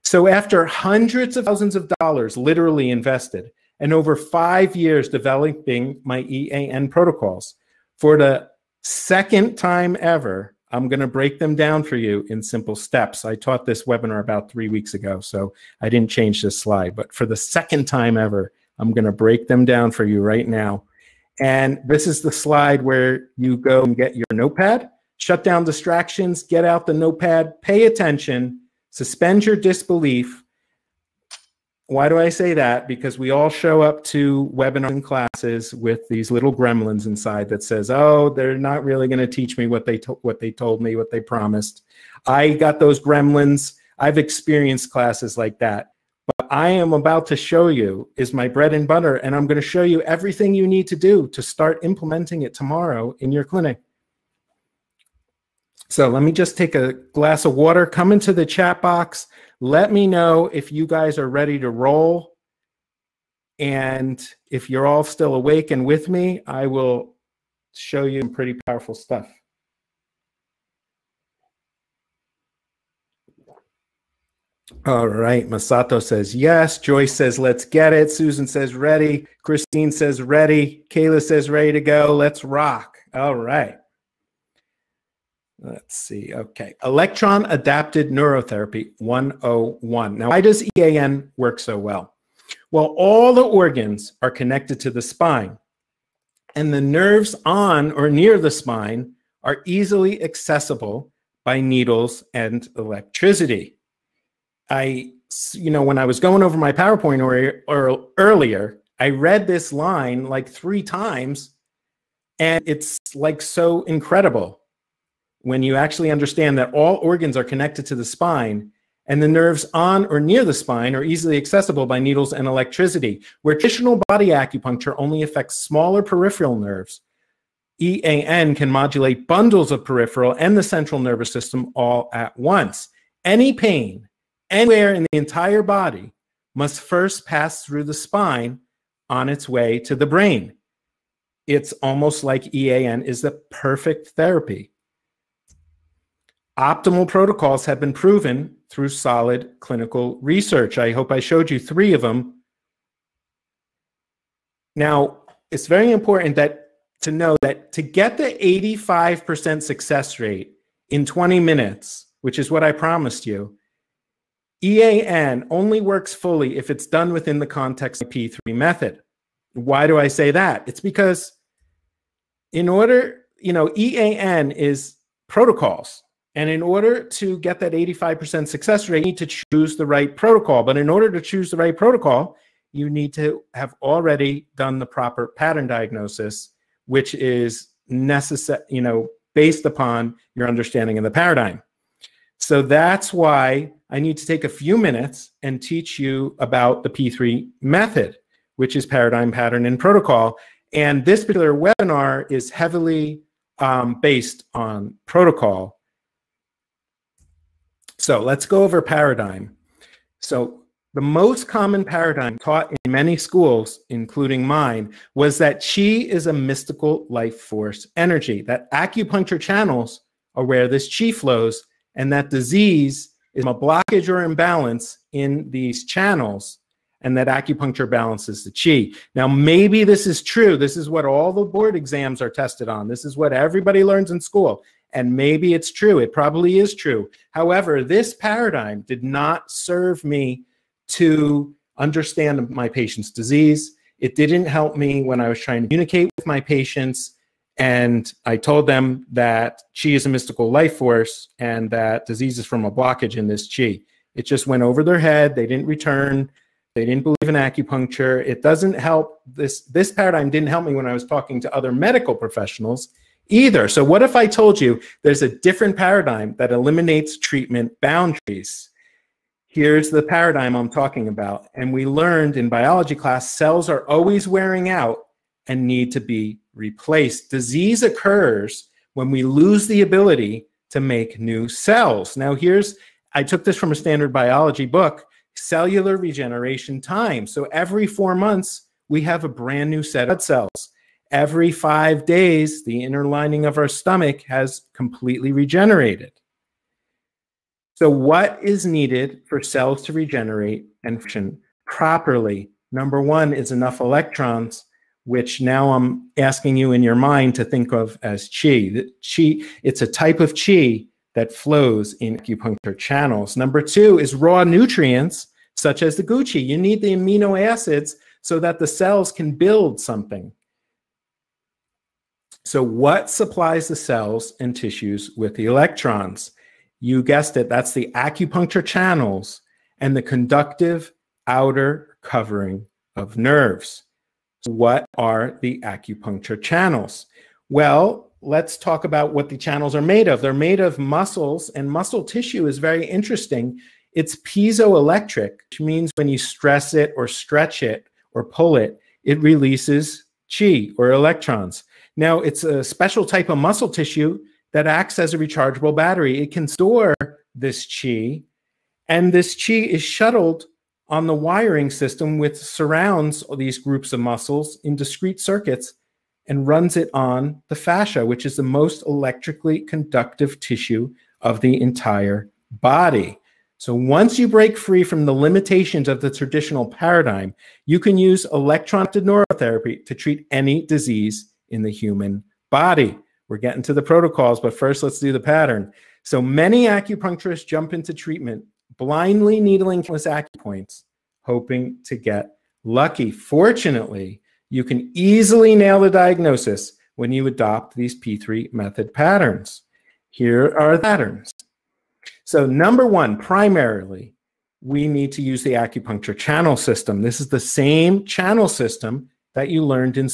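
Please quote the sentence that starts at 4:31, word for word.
And we learned in biology class, cells are always wearing out and need to be replaced.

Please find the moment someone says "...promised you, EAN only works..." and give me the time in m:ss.
2:42.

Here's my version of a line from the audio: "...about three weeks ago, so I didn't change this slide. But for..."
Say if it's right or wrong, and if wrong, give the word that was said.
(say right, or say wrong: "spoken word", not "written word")
right.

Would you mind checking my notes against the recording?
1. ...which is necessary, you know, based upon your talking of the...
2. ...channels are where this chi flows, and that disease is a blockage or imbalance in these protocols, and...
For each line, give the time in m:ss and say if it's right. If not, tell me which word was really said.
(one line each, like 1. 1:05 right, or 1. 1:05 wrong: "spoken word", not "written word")
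1. 3:06 wrong: "understanding", not "talking"
2. 3:39 wrong: "channels", not "protocols".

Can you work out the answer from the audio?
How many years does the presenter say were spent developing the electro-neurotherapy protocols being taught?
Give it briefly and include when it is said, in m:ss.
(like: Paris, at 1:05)
5, at 0:04.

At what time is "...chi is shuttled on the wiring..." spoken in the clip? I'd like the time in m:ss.
5:59.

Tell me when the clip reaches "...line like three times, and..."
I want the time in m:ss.
1:49.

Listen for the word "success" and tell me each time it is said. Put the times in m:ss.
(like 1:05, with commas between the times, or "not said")
2:39, 2:58.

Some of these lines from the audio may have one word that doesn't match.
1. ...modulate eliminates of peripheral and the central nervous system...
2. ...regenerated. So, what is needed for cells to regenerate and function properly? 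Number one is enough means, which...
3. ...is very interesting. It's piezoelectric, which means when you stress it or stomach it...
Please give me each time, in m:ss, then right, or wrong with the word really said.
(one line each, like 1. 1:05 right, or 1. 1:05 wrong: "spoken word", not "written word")
1. 2:08 wrong: "bundles", not "eliminates"
2. 4:55 wrong: "electrons", not "means"
3. 5:42 wrong: "stretch", not "stomach".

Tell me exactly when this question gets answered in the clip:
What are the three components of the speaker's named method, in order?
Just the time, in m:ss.
3:18.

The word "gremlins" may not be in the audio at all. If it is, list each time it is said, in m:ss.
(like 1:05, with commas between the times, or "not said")
0:36, 0:42.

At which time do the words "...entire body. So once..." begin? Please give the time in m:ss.
6:11.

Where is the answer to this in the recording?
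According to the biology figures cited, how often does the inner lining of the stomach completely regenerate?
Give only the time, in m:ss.
4:51.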